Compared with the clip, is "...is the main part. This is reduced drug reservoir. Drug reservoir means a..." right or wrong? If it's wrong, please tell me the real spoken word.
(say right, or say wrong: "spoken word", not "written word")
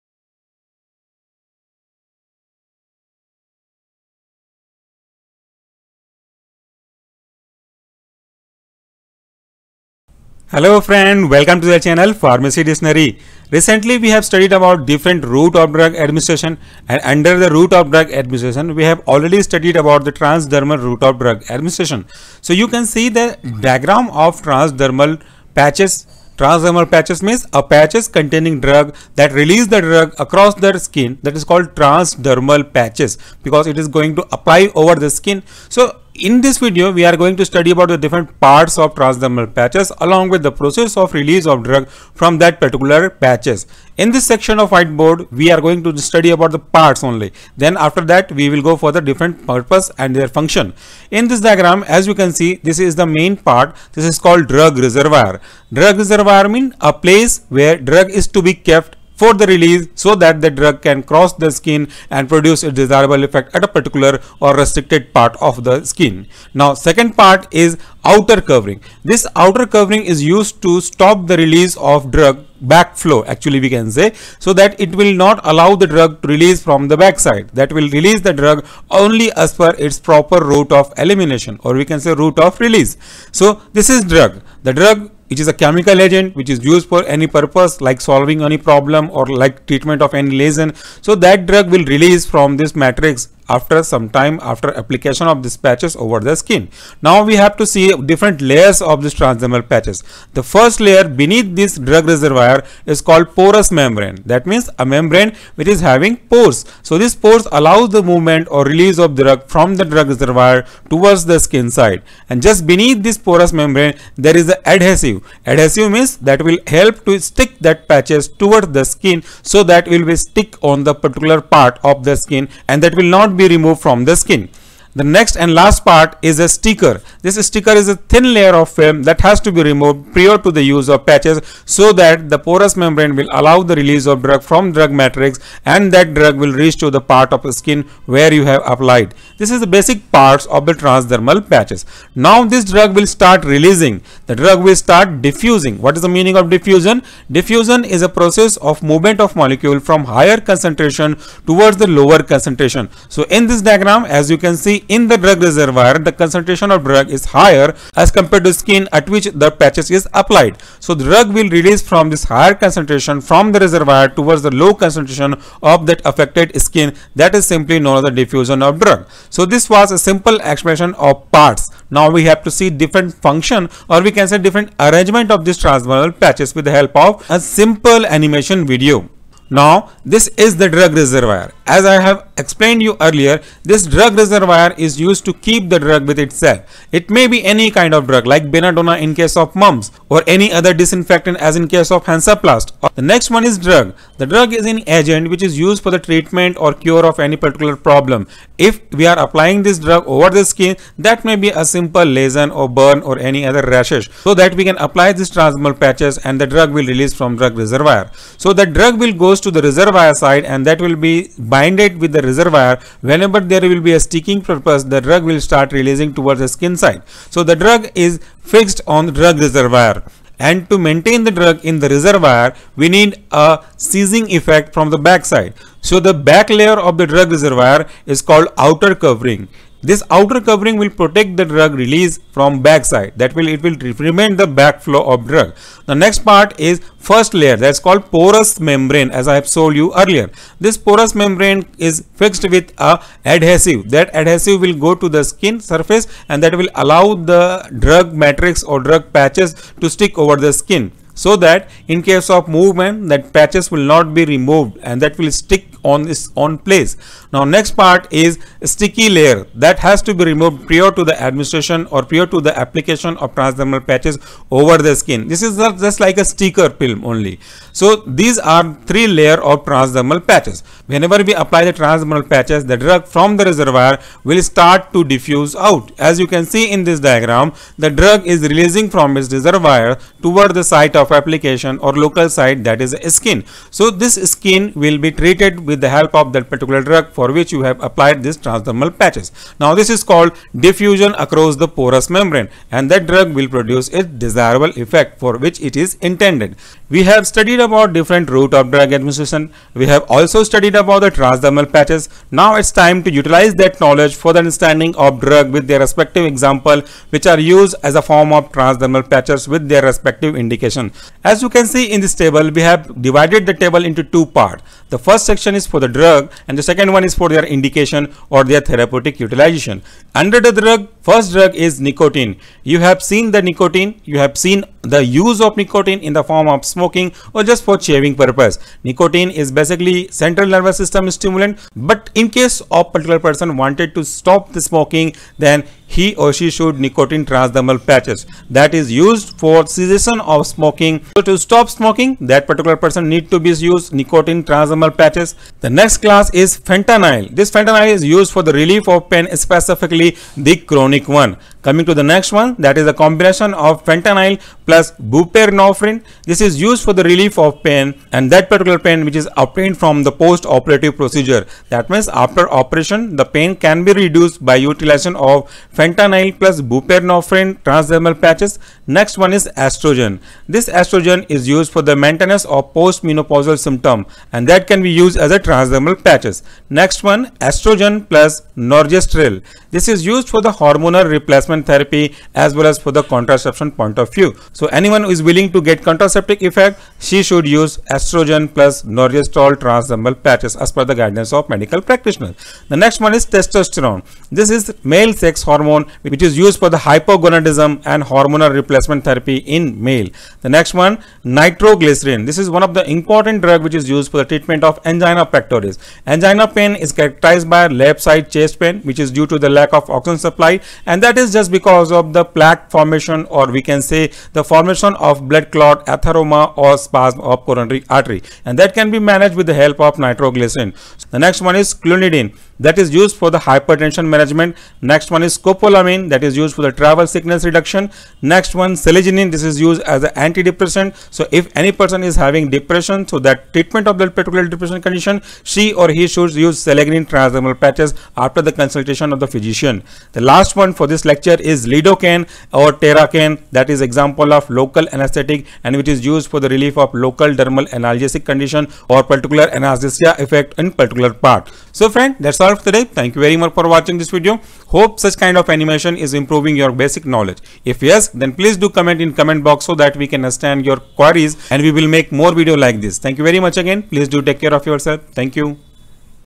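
wrong: "called", not "reduced".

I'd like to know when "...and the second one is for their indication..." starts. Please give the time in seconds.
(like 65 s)
316 s.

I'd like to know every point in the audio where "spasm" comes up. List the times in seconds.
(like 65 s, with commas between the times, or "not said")
416 s.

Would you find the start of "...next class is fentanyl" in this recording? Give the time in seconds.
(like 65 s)
345 s.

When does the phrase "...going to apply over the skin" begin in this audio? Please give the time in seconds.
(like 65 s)
33 s.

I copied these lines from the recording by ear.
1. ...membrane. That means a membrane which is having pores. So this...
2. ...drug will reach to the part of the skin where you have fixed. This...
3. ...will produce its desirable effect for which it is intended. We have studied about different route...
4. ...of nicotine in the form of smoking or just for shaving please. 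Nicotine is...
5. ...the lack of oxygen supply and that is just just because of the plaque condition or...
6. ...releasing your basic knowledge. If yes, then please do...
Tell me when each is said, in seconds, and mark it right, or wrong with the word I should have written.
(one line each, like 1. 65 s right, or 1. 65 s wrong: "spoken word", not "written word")
1. 103 s right
2. 136 s wrong: "applied", not "fixed"
3. 293 s right
4. 325 s wrong: "purpose", not "please"
5. 409 s wrong: "formation", not "condition"
6. 456 s wrong: "improving", not "releasing".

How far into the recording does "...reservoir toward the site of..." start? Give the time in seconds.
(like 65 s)
279 s.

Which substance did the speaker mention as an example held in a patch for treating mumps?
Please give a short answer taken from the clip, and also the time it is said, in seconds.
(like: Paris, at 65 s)
Belladonna, at 188 s.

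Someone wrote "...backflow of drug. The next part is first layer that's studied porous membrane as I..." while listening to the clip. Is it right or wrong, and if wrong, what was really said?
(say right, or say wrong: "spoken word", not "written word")
wrong: "called", not "studied".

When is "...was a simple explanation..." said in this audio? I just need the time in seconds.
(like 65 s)
169 s.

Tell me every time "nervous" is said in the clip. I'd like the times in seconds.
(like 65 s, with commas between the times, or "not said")
330 s.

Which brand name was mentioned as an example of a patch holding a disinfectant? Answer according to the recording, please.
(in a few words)
Hansaplast.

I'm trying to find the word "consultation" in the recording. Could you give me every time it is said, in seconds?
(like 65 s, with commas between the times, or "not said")
438 s.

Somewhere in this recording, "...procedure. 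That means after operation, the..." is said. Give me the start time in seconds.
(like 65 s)
360 s.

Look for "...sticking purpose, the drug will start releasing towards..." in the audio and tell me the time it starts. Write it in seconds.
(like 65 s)
213 s.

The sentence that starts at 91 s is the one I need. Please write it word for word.
So that drug will release from this matrix after some time after application of these patches over the skin.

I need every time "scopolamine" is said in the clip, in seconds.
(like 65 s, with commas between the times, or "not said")
425 s.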